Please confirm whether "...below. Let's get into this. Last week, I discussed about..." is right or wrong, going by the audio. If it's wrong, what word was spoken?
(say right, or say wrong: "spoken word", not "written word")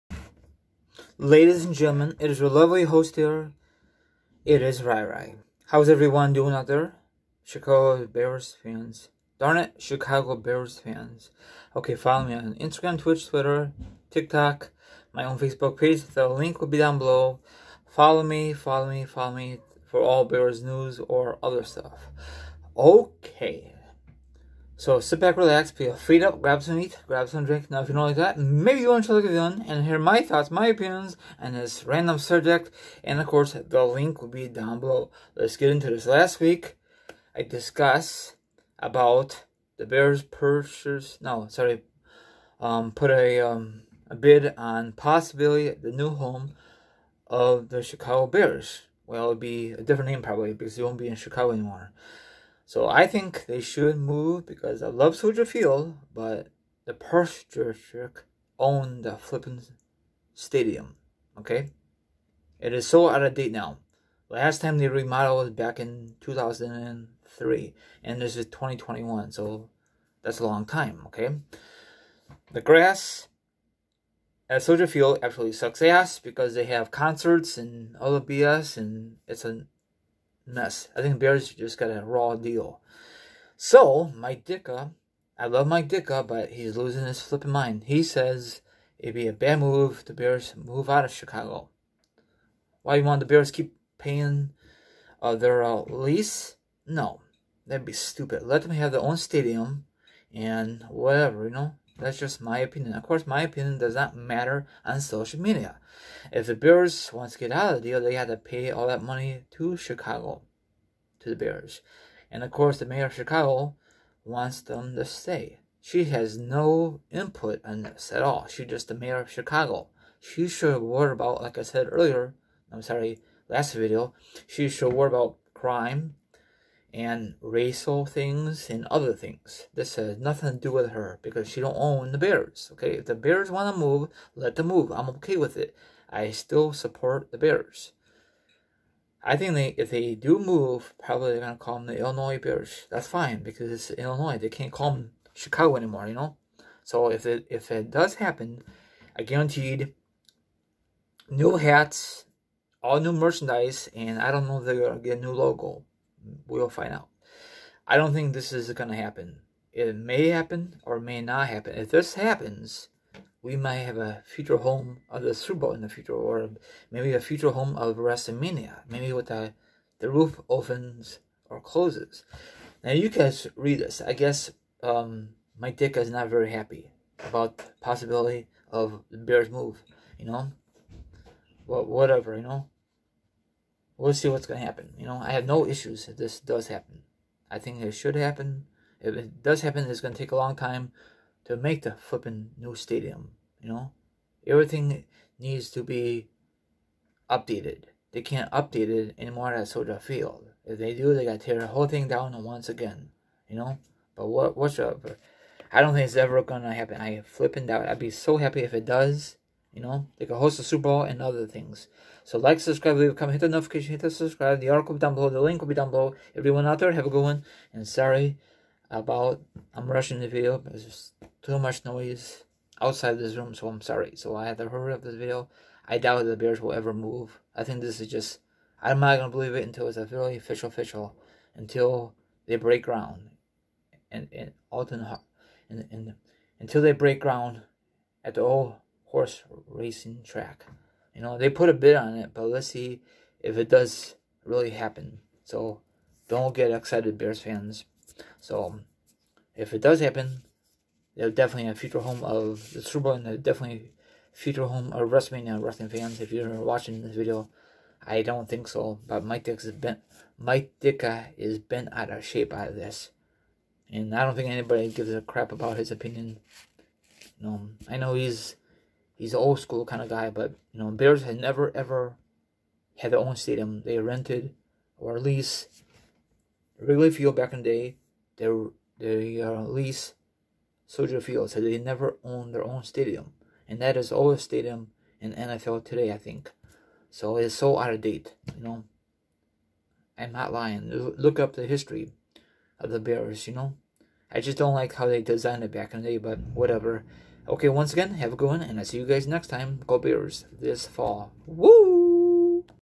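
right.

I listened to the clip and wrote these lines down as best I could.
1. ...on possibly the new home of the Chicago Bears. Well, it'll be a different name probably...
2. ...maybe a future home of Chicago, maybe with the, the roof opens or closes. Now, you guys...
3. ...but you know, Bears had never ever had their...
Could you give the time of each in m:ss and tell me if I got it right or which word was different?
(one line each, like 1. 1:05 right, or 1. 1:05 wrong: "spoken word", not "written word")
1. 0:44 right
2. 2:46 wrong: "WrestleMania", not "Chicago"
3. 4:30 right.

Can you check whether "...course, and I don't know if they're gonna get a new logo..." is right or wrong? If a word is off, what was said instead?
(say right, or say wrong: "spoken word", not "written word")
wrong: "merchandise", not "course".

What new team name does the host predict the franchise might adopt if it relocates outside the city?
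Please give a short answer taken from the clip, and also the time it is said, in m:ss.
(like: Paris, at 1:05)
Illinois Bears, at 2:21.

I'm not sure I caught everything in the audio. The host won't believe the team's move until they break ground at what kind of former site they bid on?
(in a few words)
horse racing track.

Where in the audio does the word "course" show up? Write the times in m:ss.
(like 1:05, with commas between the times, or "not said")
0:33, 1:43, 1:52.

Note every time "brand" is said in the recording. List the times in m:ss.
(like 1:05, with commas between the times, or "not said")
not said.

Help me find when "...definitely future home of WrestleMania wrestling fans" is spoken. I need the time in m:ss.
4:13.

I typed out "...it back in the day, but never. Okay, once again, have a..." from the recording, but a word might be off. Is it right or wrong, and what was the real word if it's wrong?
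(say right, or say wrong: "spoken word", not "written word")
wrong: "whatever", not "never".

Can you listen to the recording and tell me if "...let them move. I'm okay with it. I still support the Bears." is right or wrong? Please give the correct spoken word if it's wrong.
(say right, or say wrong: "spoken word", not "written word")
right.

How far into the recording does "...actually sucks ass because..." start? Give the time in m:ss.
1:15.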